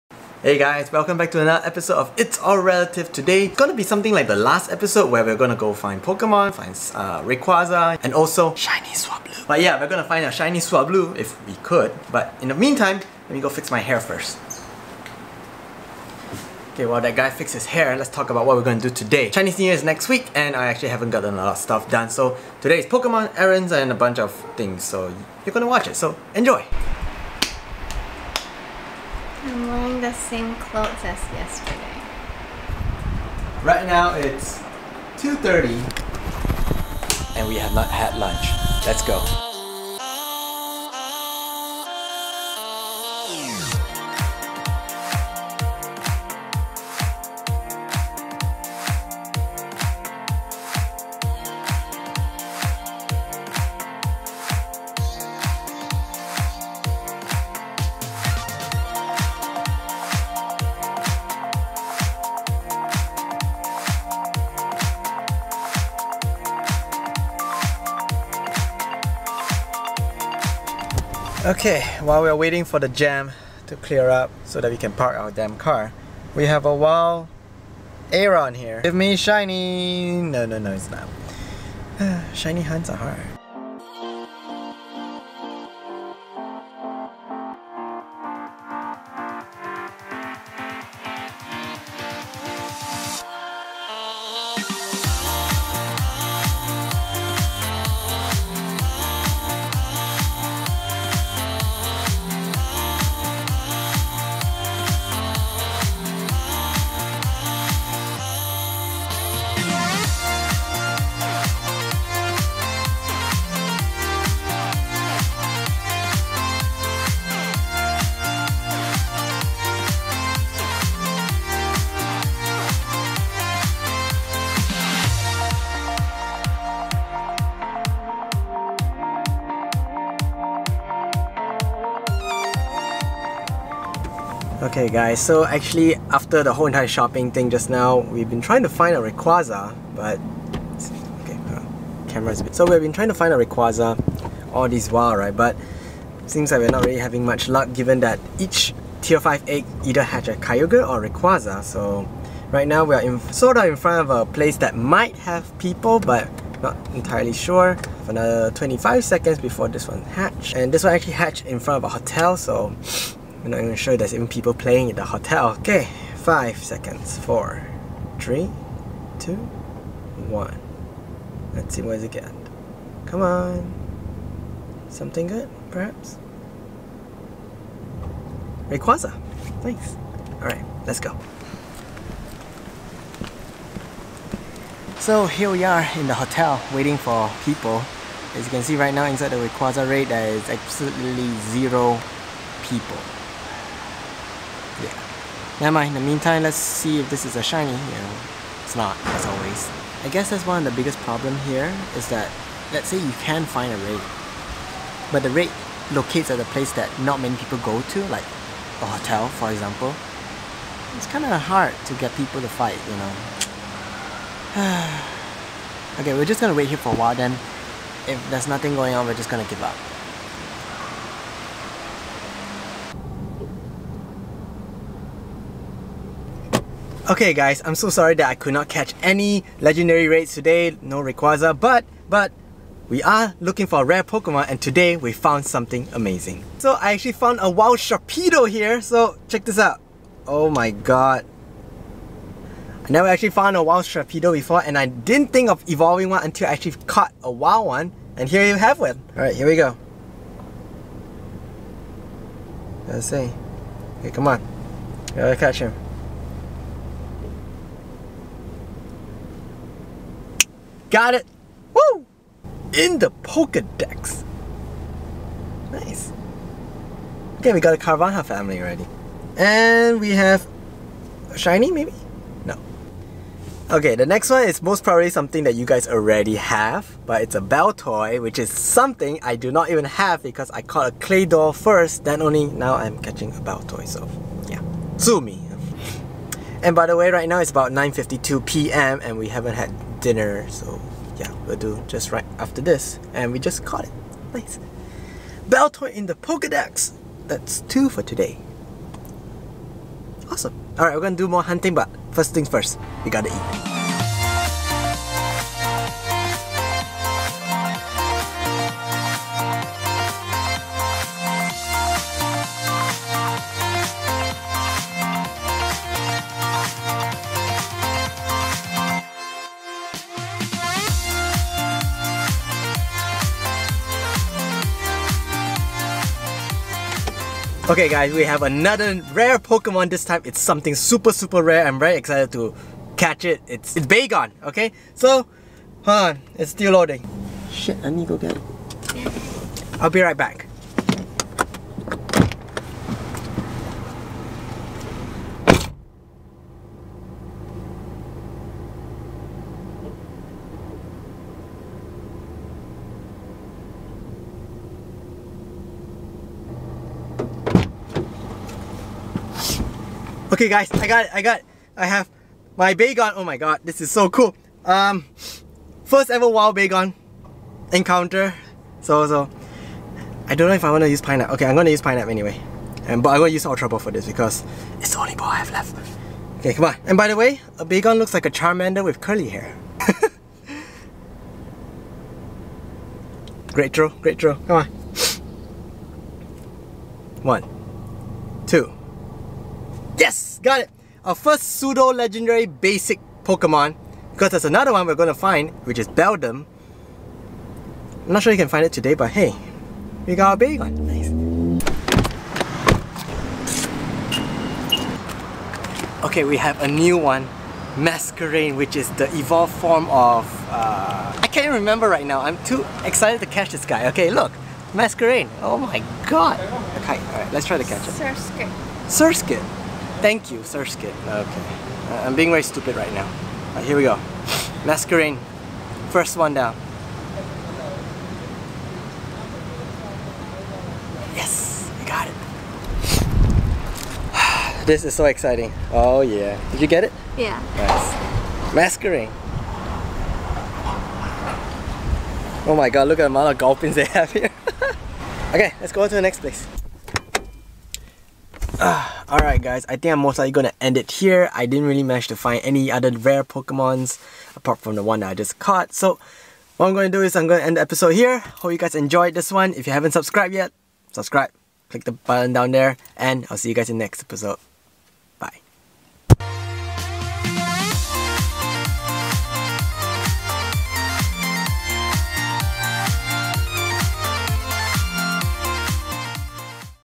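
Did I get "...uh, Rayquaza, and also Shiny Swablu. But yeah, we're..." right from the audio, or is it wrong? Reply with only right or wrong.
right.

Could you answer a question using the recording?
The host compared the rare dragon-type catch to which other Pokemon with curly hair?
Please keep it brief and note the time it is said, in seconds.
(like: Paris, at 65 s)
Charmander, at 378 s.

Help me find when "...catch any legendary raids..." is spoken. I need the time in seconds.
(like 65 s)
228 s.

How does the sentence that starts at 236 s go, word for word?
So I actually found a wild Sharpedo here, so check this out.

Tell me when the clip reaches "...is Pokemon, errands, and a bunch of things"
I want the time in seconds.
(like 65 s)
22 s.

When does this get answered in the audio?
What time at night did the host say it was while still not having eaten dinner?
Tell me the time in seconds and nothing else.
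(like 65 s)
287 s.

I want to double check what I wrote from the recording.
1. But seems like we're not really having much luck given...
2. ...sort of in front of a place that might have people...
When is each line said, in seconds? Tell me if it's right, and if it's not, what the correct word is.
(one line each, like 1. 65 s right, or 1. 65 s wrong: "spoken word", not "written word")
1. 145 s right
2. 153 s right.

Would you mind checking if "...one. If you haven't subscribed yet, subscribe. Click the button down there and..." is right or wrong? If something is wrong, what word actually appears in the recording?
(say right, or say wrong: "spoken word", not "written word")
right.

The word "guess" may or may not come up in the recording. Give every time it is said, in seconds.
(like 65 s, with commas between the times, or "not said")
200 s.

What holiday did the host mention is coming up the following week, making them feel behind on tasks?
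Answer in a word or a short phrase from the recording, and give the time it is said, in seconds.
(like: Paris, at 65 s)
Chinese New Year, at 19 s.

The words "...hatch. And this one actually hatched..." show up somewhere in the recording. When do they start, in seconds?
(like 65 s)
160 s.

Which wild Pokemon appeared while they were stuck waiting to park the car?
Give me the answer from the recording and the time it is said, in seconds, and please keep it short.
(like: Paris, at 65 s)
Aron, at 78 s.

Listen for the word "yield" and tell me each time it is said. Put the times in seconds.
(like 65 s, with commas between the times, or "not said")
not said.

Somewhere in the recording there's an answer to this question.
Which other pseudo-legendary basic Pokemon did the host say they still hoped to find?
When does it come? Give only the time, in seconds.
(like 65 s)
395 s.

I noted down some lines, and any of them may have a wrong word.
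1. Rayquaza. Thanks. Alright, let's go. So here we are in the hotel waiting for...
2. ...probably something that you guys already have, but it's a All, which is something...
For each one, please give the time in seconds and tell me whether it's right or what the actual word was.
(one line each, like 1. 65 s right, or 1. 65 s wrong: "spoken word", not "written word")
1. 178 s right
2. 274 s wrong: "Baltoy", not "All".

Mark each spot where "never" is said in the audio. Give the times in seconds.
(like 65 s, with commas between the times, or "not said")
195 s, 242 s.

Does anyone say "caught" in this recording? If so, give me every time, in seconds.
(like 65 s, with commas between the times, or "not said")
246 s, 280 s, 293 s, 455 s.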